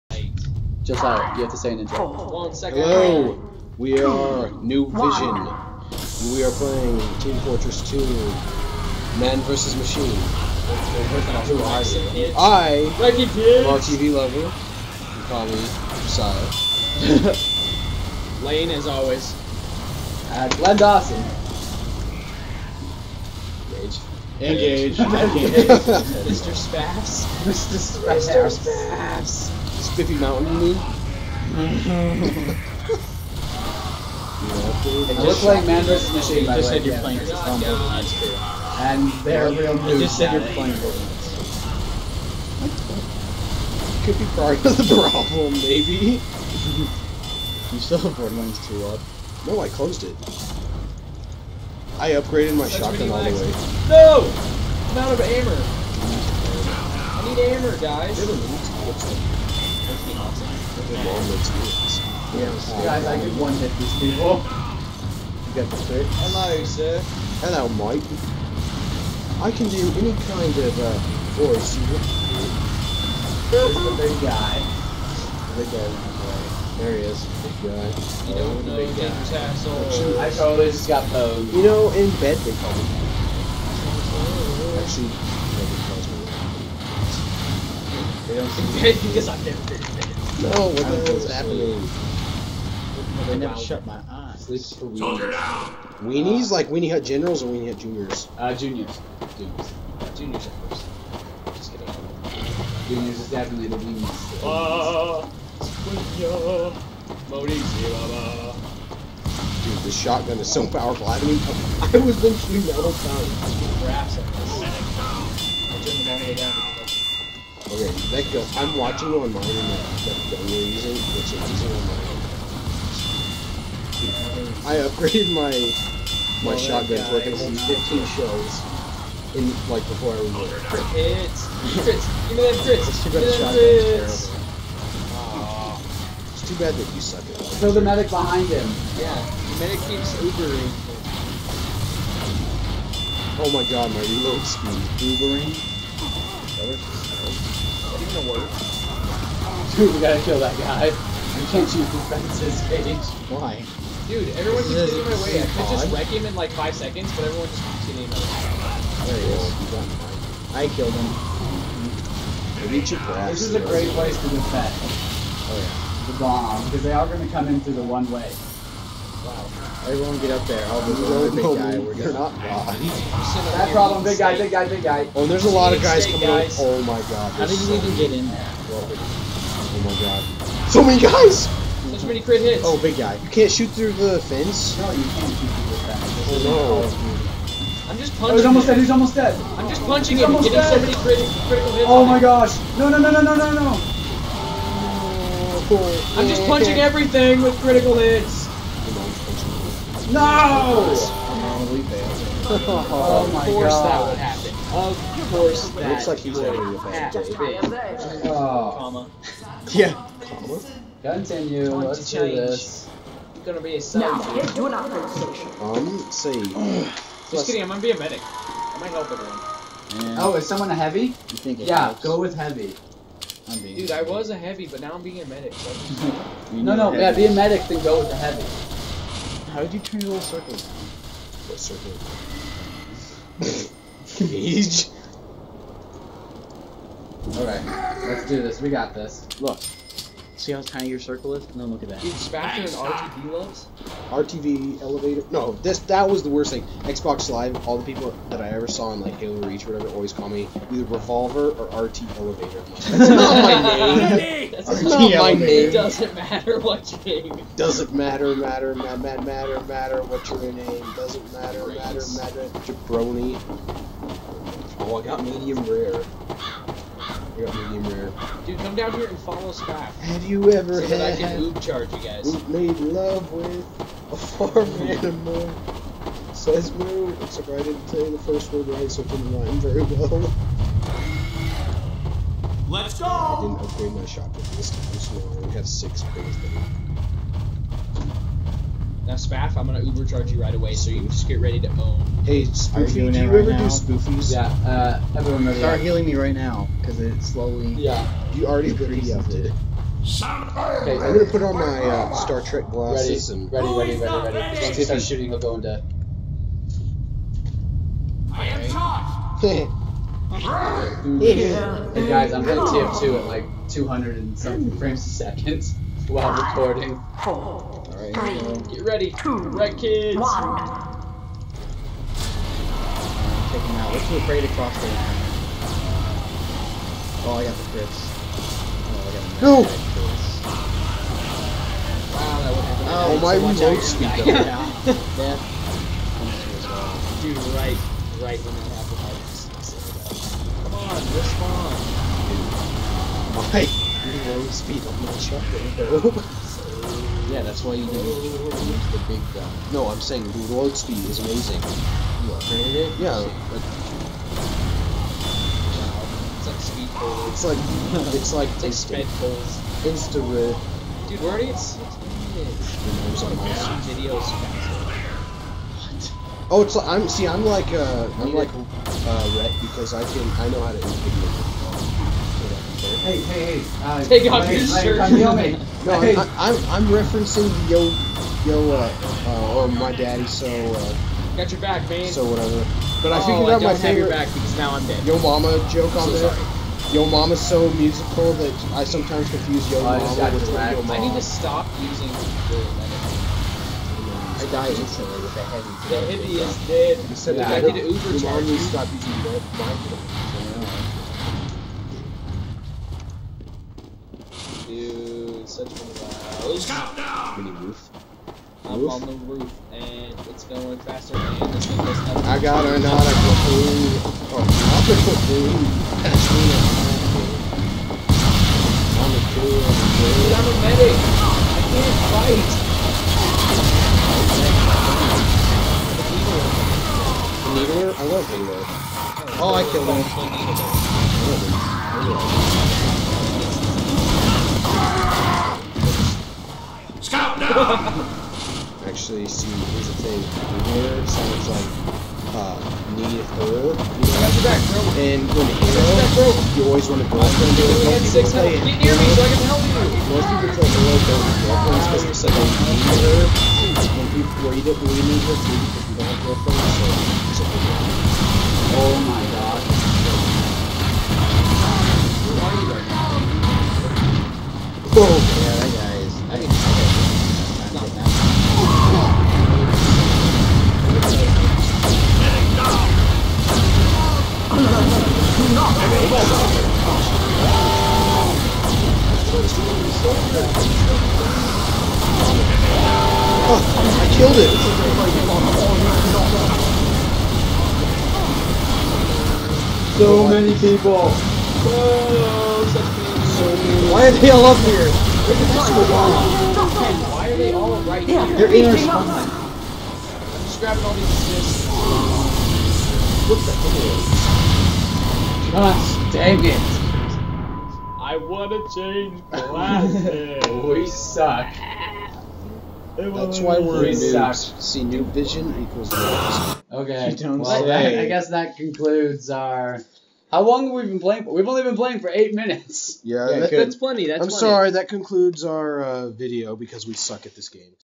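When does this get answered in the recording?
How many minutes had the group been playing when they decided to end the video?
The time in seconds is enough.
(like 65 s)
522 s.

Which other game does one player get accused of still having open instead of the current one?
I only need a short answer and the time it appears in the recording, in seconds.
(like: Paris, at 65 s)
Borderlands 2, at 48 s.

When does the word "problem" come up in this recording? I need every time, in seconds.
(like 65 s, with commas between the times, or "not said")
45 s, 173 s.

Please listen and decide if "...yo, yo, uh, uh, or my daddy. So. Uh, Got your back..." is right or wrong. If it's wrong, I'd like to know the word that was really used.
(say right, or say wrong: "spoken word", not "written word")
right.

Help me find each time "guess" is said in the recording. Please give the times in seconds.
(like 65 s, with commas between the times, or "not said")
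518 s.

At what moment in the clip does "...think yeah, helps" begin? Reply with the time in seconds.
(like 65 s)
221 s.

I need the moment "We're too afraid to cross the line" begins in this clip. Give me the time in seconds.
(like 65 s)
323 s.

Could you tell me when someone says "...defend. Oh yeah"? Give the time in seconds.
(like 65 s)
164 s.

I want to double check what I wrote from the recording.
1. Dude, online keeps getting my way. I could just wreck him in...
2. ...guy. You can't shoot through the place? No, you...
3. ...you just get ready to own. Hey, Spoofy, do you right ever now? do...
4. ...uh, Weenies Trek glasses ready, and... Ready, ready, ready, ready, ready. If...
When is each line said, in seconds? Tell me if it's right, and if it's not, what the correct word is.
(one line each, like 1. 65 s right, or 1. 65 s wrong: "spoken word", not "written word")
1. 154 s wrong: "everyone", not "online"
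2. 182 s wrong: "fence", not "place"
3. 290 s right
4. 301 s wrong: "Star", not "Weenies".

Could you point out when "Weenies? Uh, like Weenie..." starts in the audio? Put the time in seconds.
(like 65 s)
96 s.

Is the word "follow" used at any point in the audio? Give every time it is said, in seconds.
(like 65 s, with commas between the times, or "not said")
269 s.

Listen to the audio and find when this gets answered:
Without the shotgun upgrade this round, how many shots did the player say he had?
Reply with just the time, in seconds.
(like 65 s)
285 s.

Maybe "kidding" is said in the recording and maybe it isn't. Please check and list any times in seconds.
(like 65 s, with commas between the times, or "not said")
101 s, 217 s.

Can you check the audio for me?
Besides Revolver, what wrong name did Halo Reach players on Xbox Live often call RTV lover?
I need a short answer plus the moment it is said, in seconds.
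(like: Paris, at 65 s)
RT Elevator, at 251 s.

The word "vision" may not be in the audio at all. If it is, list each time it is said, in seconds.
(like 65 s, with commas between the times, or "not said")
4 s, 515 s.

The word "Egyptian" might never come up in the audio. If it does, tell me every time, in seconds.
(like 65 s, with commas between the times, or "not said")
not said.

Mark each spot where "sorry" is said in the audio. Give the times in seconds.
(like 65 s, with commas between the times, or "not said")
386 s, 524 s.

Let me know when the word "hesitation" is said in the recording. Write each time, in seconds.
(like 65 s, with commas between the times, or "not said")
not said.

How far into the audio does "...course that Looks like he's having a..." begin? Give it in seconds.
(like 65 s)
205 s.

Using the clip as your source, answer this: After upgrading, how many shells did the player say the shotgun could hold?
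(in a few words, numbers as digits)
15.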